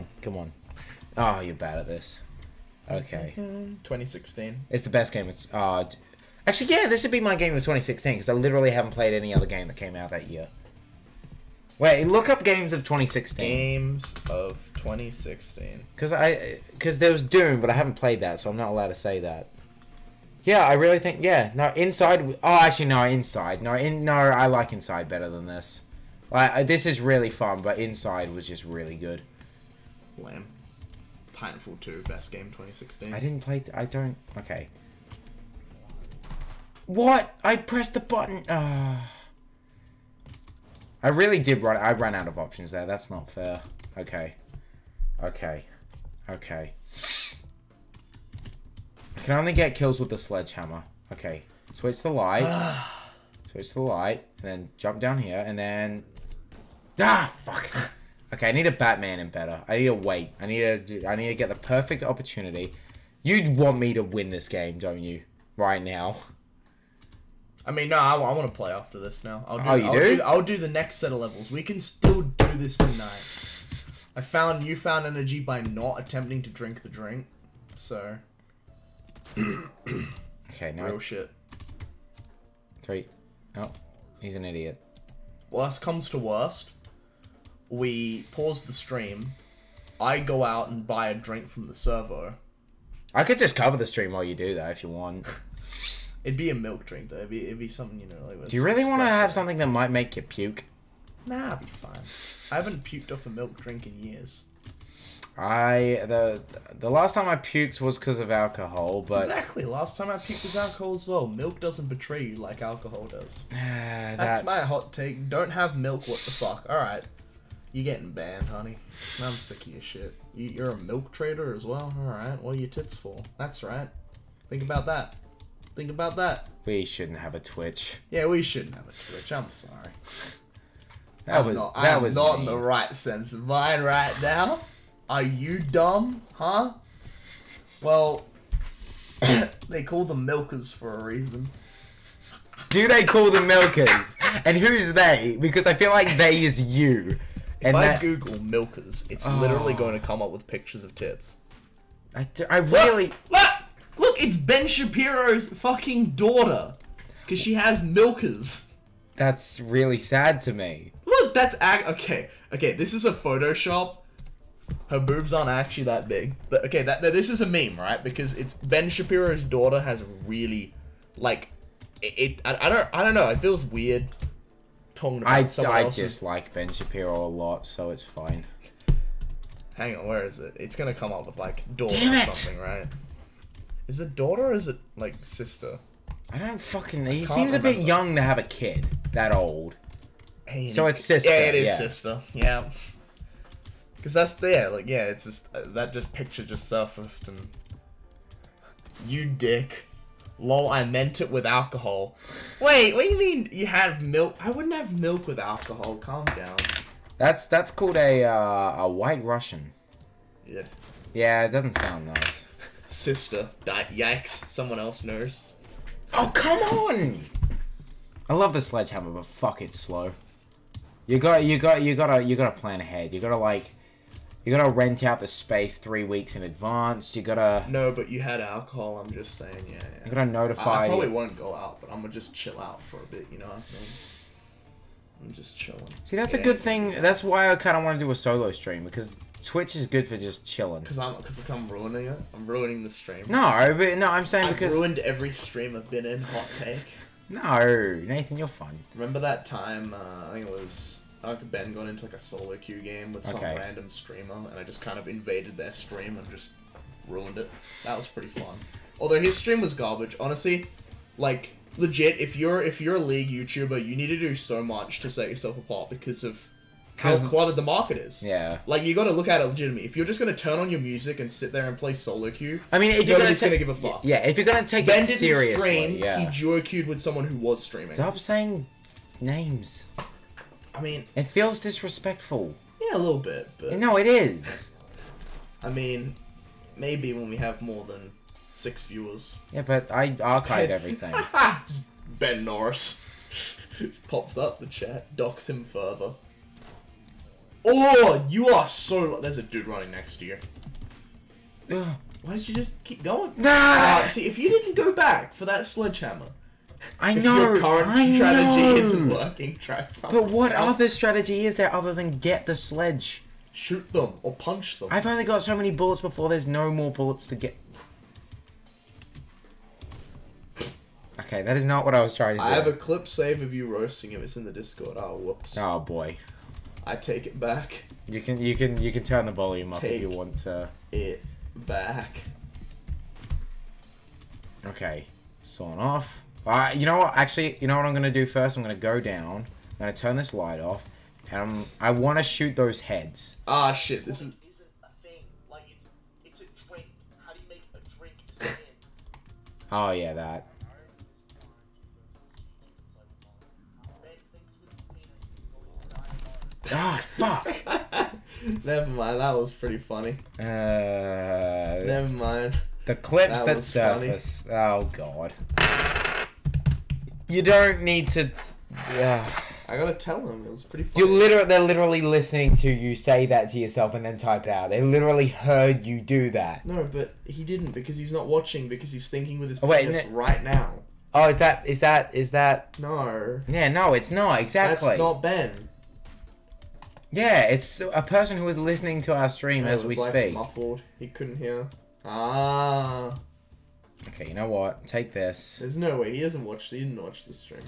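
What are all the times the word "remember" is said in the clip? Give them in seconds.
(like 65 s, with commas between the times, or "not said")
187 s, 248 s.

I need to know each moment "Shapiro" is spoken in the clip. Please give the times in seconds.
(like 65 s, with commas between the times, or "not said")
154 s, 168 s, 176 s.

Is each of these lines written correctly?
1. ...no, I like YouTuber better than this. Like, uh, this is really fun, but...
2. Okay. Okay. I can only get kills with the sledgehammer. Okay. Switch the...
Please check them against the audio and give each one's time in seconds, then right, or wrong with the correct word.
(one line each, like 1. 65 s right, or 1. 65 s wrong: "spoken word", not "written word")
1. 24 s wrong: "Inside", not "YouTuber"
2. 45 s right.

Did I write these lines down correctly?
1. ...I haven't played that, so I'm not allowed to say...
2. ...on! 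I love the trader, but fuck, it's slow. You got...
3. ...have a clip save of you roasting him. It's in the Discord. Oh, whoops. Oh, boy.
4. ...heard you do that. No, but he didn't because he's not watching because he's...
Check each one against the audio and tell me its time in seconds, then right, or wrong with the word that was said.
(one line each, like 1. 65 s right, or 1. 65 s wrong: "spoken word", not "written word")
1. 17 s right
2. 216 s wrong: "sledgehammer", not "trader"
3. 322 s right
4. 375 s right.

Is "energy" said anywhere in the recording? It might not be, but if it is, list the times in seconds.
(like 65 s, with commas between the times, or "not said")
75 s.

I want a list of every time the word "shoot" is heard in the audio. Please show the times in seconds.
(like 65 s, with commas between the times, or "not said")
313 s, 342 s.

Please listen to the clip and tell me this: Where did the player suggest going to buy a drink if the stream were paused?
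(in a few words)
The servo.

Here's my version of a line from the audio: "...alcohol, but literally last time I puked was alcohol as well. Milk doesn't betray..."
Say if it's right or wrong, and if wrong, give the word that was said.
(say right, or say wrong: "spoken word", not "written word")
wrong: "exactly", not "literally".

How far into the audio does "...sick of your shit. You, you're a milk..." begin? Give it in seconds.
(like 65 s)
119 s.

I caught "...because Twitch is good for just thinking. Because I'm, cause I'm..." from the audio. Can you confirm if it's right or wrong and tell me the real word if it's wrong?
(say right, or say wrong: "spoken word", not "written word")
wrong: "chilling", not "thinking".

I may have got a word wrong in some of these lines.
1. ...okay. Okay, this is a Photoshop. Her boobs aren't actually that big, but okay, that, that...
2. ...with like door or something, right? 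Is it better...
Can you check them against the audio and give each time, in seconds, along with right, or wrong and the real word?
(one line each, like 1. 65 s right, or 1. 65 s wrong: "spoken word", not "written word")
1. 161 s right
2. 181 s wrong: "daughter", not "better".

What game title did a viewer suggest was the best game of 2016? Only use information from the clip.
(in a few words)
Titanfall 2.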